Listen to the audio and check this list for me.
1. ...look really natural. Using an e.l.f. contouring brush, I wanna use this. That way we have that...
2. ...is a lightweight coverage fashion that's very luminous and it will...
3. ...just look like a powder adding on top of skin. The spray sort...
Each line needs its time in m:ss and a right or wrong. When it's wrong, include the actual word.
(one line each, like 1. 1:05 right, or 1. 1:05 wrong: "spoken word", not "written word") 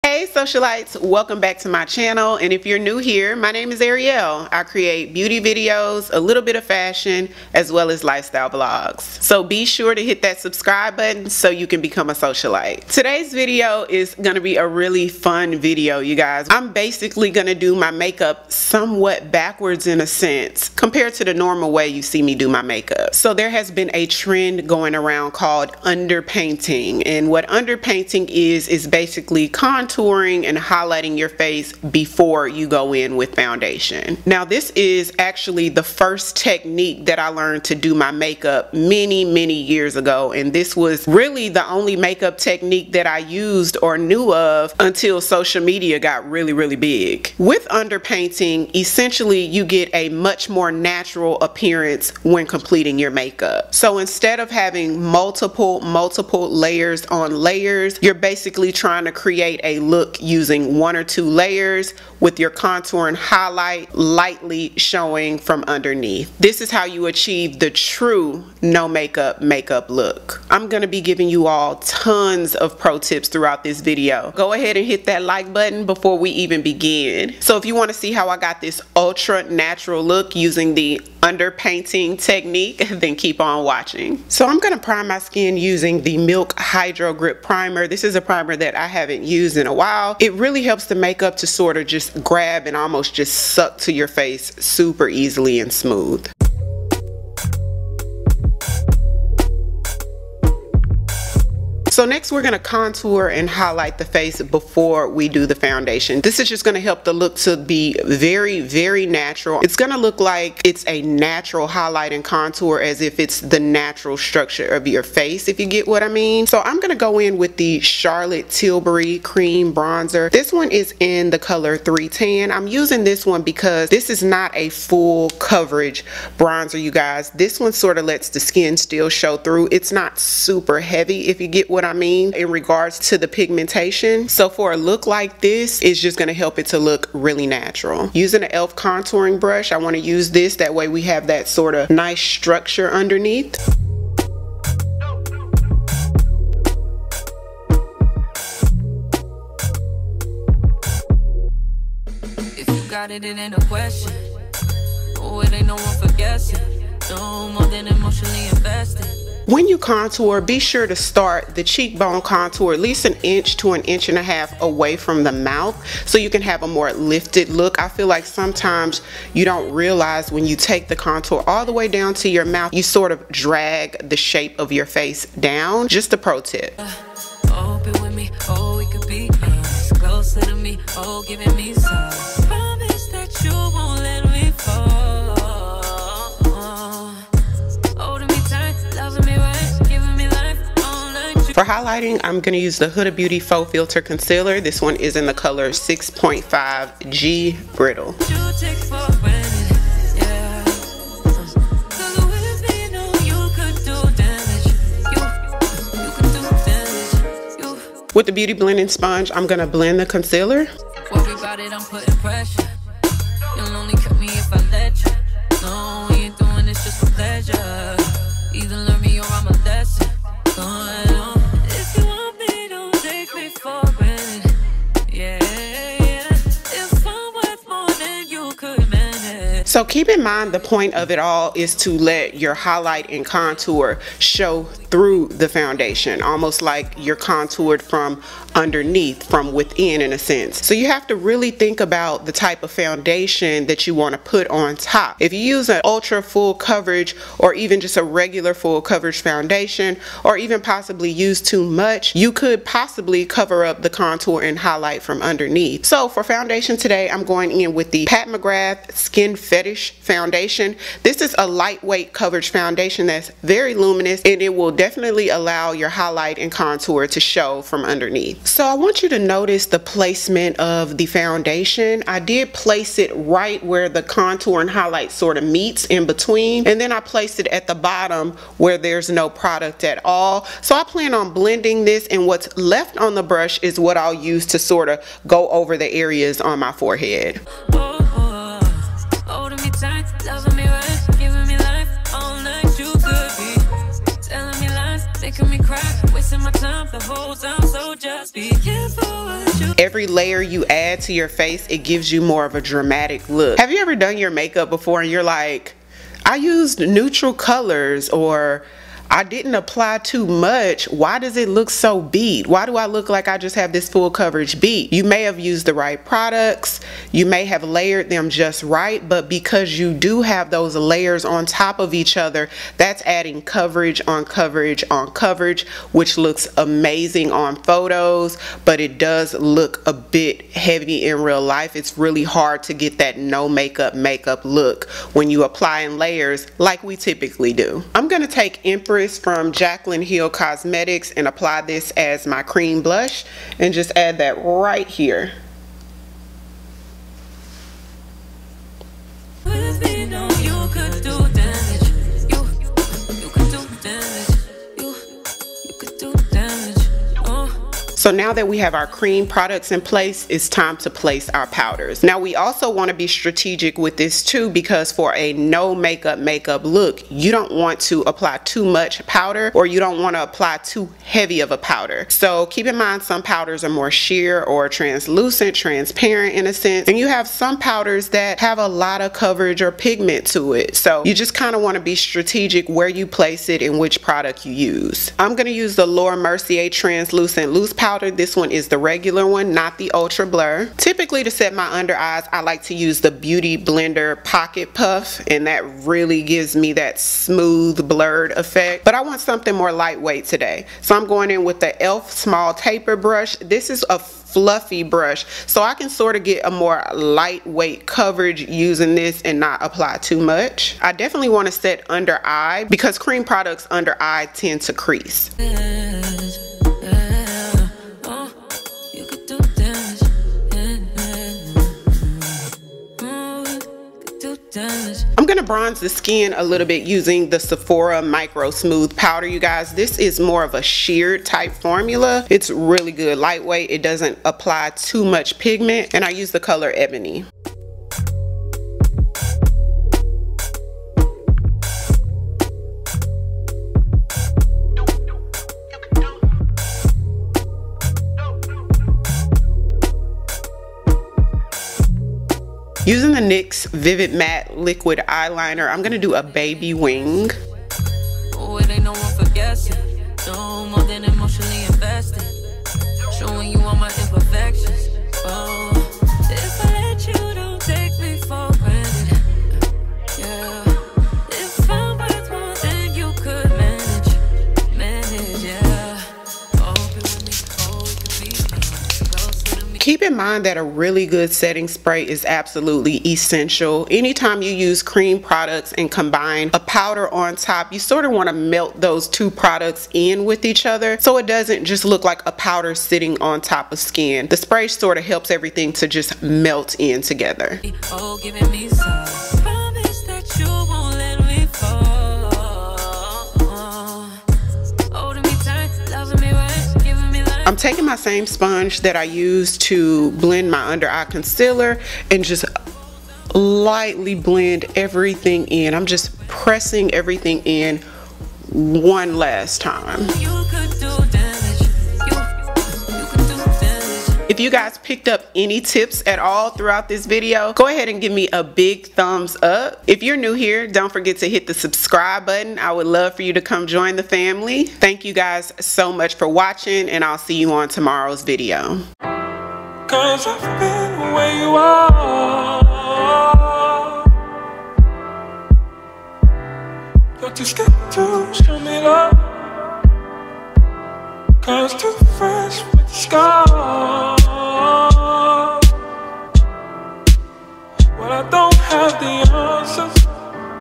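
1. 2:16 right
2. 4:21 wrong: "foundation", not "fashion"
3. 8:11 wrong: "sitting", not "adding".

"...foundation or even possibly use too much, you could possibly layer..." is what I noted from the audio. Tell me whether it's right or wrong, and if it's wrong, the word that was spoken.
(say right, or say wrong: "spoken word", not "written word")
wrong: "cover", not "layer".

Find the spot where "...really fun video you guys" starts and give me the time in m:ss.
0:14.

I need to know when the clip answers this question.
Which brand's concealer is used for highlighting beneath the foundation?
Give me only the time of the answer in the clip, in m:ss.
3:12.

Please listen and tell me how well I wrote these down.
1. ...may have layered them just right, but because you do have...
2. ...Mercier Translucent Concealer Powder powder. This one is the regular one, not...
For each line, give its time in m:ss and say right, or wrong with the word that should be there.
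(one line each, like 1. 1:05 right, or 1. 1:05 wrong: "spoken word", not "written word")
1. 5:17 right
2. 6:26 wrong: "Loose", not "Concealer".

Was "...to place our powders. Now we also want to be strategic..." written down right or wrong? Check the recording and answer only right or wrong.
right.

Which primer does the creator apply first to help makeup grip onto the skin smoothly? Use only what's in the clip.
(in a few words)
Milk Hydro Grip Primer.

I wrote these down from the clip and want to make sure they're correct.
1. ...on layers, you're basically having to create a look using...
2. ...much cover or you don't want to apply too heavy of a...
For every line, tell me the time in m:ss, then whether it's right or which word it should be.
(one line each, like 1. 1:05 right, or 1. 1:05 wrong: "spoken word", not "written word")
1. 0:57 wrong: "trying", not "having"
2. 6:08 wrong: "powder", not "cover".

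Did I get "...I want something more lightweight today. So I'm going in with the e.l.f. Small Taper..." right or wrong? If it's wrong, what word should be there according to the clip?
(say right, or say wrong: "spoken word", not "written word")
right.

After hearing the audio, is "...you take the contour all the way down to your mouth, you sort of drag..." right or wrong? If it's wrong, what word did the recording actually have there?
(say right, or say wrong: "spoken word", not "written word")
right.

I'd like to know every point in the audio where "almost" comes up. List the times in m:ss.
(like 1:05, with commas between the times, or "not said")
1:32, 3:56.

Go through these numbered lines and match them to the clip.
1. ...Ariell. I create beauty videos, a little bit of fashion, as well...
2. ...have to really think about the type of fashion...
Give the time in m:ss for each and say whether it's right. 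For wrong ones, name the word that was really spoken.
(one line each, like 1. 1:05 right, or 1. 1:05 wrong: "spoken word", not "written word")
1. 0:03 right
2. 4:00 wrong: "foundation", not "fashion".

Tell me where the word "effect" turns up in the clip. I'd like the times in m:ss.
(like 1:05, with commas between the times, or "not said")
6:38.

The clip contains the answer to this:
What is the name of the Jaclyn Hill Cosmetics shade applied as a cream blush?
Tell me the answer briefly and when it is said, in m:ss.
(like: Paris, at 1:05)
Empress, at 5:38.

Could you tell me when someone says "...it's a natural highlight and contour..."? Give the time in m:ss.
1:50.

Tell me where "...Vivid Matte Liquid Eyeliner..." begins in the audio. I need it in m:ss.
7:33.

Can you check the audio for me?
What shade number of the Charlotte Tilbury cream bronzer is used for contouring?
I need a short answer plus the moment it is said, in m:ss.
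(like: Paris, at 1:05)
310, at 2:01.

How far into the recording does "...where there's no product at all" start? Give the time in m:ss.
4:38.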